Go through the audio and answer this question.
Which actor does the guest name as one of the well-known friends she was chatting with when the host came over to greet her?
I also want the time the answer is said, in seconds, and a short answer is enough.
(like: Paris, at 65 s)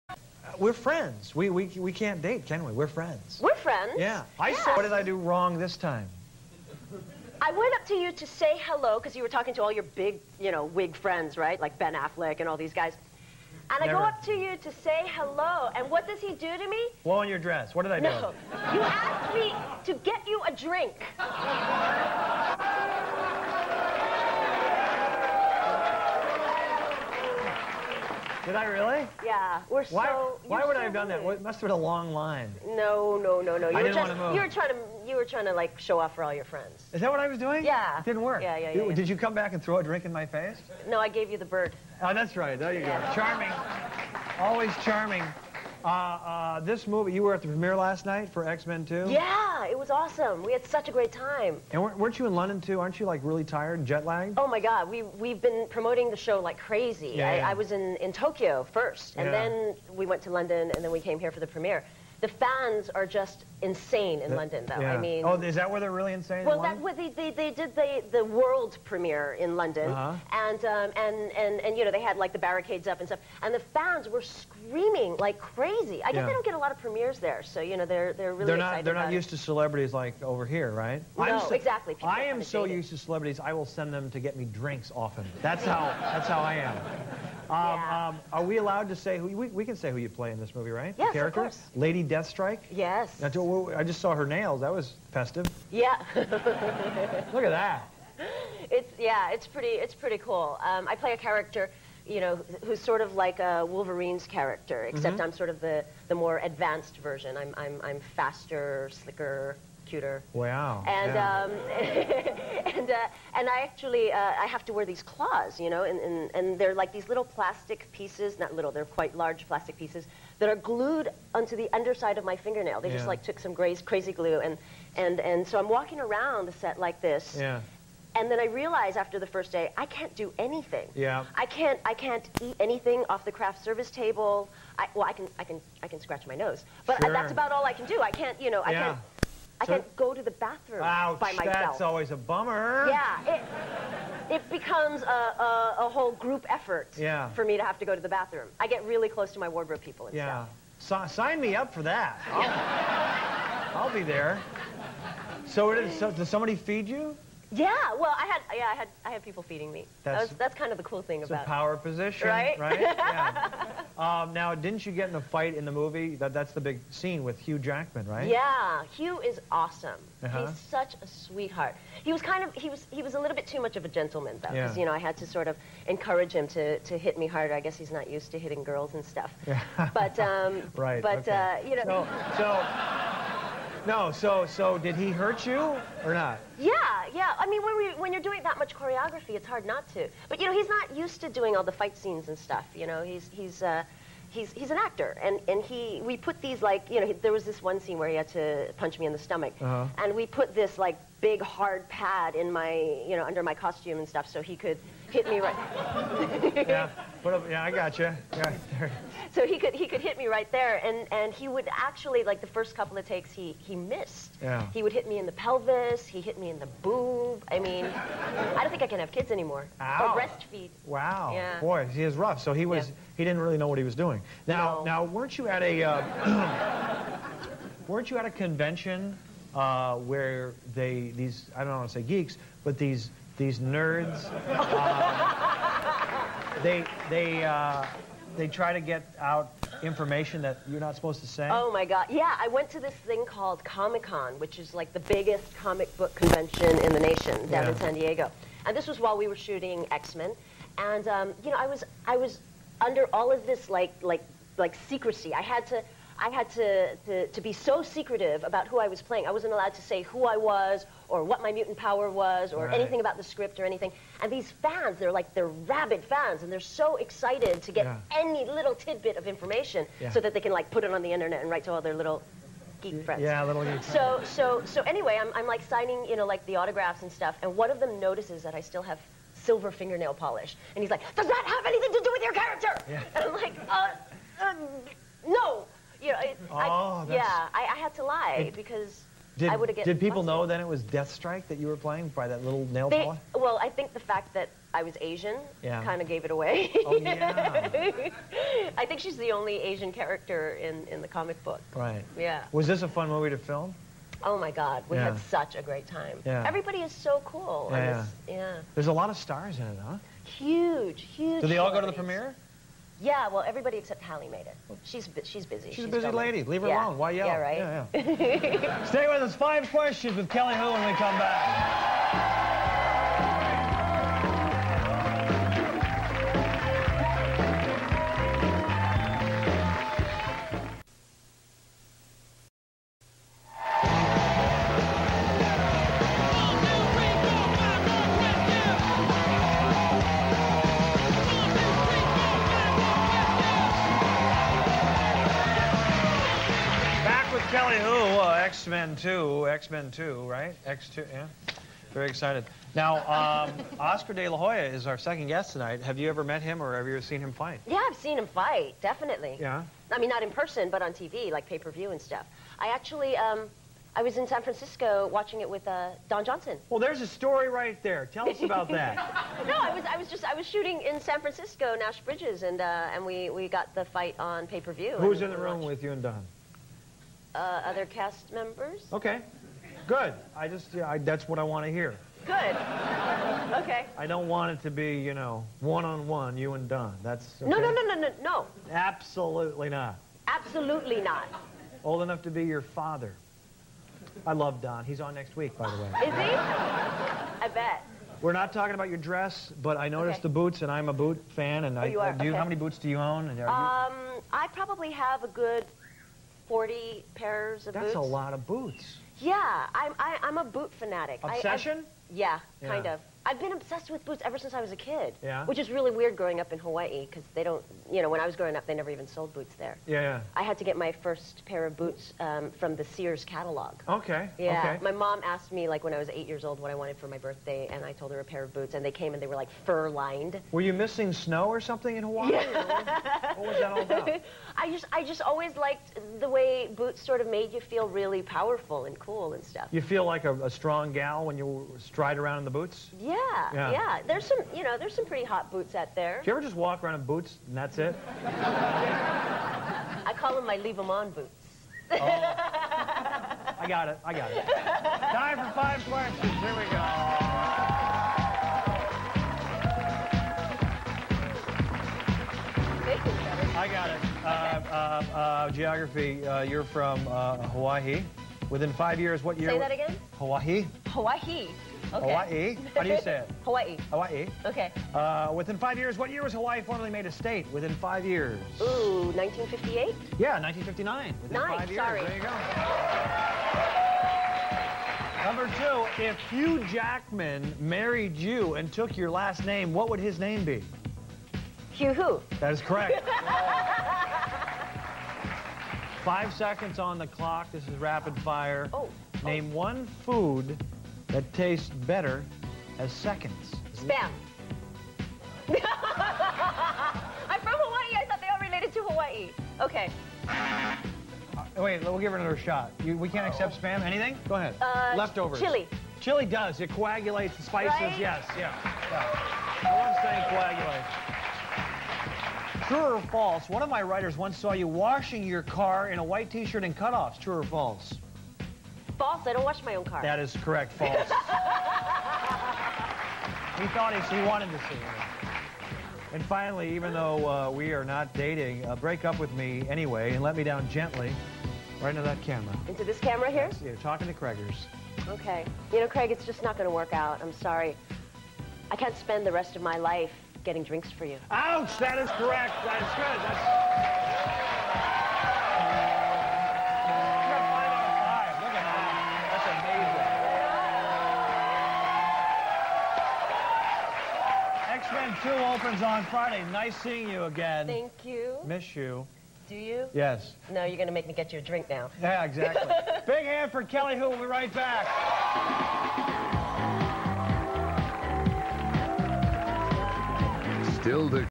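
Ben Affleck, at 11 s.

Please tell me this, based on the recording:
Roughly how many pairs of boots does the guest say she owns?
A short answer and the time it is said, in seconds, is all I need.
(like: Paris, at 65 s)
40, at 406 s.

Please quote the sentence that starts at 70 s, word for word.
and um, and and and you know they had like the barricades up and stuff, and the fans were screaming like crazy.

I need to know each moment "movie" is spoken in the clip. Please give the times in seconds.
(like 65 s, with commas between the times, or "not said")
46 s, 90 s, 165 s, 303 s.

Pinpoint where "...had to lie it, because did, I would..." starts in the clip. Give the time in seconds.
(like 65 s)
287 s.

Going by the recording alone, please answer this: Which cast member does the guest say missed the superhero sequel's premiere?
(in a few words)
Halle.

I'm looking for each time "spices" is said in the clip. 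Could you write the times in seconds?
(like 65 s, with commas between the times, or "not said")
517 s.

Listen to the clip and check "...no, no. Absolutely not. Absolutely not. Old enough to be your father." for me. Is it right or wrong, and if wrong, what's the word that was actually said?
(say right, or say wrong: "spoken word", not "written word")
right.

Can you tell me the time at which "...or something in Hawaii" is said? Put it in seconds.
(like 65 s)
431 s.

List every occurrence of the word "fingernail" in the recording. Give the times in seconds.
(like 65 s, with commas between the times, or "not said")
122 s, 279 s.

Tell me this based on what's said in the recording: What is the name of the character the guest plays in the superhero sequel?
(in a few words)
Lady Deathstrike.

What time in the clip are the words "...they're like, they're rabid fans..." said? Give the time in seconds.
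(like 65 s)
264 s.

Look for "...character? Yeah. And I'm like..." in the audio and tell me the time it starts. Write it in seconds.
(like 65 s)
282 s.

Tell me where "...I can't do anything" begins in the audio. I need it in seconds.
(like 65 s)
129 s.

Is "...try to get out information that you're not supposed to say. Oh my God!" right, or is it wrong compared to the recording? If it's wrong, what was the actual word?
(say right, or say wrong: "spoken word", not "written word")
right.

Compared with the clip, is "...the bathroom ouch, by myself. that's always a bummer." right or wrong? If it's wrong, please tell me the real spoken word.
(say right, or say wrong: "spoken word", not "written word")
right.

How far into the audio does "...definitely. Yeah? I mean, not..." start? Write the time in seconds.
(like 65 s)
358 s.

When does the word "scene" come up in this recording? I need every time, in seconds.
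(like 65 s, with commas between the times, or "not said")
166 s, 191 s, 197 s.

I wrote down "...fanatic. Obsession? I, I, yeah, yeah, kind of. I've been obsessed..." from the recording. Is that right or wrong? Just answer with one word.
right.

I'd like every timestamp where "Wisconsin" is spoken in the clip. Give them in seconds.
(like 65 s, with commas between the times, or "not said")
not said.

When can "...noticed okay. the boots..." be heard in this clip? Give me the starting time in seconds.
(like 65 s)
399 s.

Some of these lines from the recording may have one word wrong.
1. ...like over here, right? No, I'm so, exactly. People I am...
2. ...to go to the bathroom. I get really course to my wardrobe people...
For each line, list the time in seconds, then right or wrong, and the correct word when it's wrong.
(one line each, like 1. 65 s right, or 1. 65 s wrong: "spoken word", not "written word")
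1. 79 s right
2. 147 s wrong: "close", not "course".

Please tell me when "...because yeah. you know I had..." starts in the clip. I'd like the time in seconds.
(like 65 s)
174 s.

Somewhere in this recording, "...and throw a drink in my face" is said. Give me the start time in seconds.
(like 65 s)
39 s.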